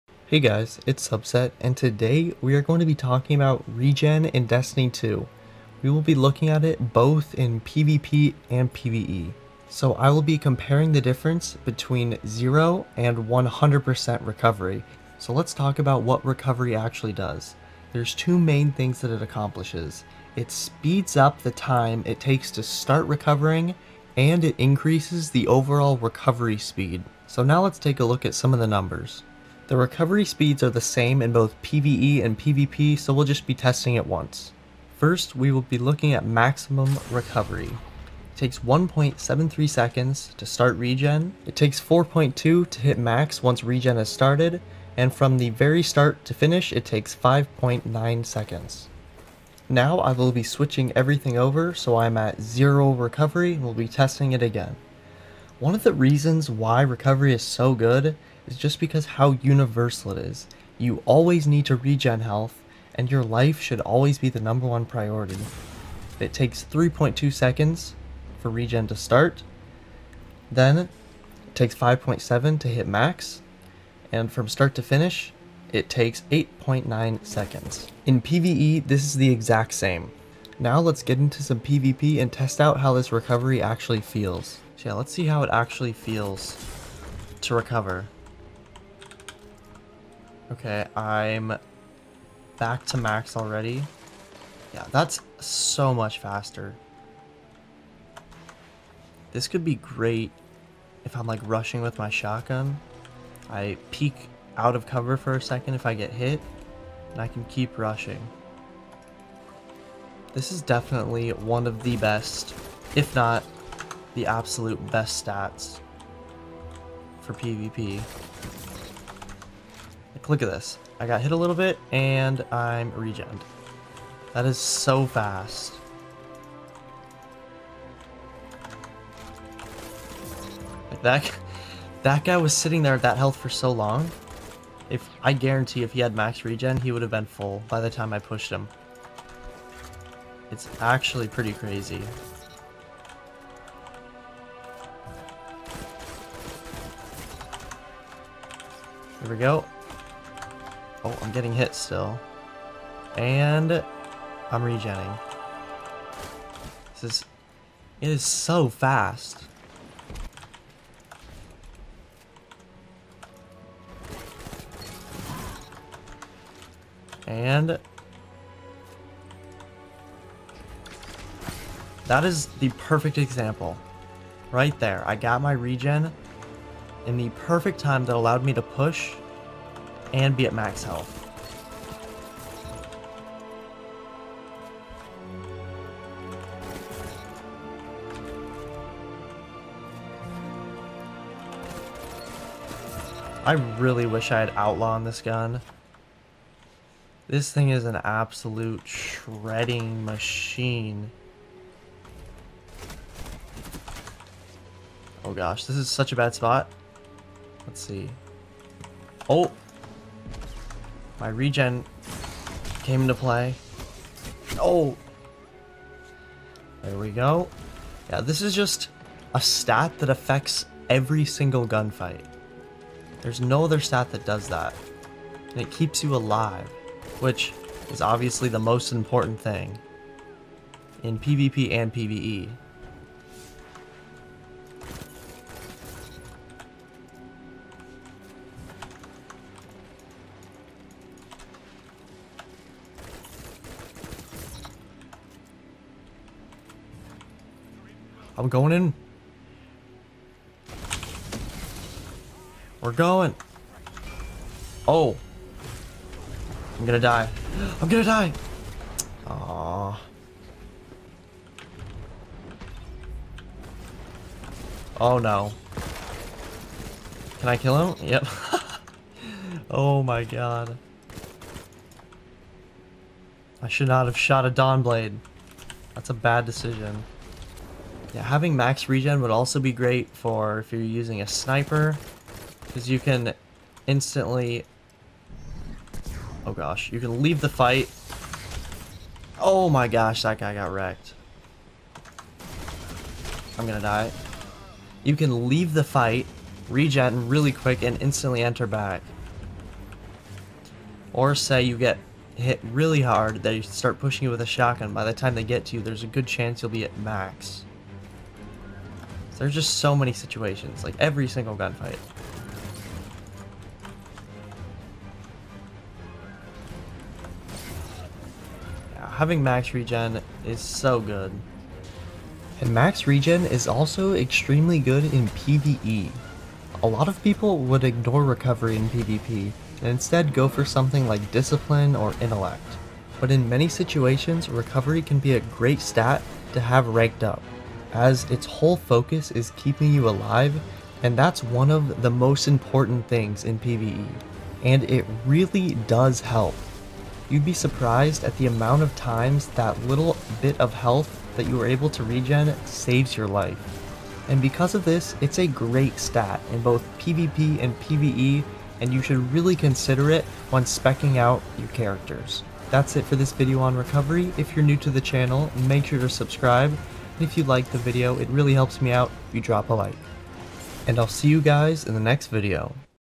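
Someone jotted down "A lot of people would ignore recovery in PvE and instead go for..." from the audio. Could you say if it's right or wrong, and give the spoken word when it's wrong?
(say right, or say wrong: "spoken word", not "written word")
wrong: "PvP", not "PvE".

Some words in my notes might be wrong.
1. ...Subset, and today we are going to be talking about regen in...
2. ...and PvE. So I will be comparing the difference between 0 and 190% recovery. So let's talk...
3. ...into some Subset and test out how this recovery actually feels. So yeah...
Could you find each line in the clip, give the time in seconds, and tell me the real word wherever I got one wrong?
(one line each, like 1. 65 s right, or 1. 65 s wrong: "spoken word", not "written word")
1. 1 s right
2. 8 s wrong: "100", not "190"
3. 81 s wrong: "PvP", not "Subset".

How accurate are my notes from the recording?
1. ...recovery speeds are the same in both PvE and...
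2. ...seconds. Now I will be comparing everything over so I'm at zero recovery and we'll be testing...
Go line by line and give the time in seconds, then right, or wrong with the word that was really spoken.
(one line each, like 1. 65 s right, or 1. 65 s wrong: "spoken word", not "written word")
1. 29 s right
2. 48 s wrong: "switching", not "comparing".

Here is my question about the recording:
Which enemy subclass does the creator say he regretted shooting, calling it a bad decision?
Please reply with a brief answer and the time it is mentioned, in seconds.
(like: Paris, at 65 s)
Dawnblade, at 274 s.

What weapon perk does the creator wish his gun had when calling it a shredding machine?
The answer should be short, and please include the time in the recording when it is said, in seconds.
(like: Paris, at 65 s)
Outlaw, at 194 s.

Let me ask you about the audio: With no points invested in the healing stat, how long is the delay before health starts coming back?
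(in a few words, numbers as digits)
3.2 seconds.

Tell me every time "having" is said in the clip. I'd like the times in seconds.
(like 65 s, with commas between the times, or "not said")
278 s, 319 s.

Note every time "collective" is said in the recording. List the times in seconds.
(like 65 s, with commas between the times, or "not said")
not said.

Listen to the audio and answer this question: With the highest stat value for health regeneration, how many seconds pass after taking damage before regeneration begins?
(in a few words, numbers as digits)
1.73 seconds.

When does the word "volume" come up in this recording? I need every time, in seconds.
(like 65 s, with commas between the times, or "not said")
not said.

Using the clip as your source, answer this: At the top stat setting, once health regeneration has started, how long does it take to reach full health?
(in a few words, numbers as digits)
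4.2 seconds.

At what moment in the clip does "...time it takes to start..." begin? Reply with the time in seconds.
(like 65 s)
21 s.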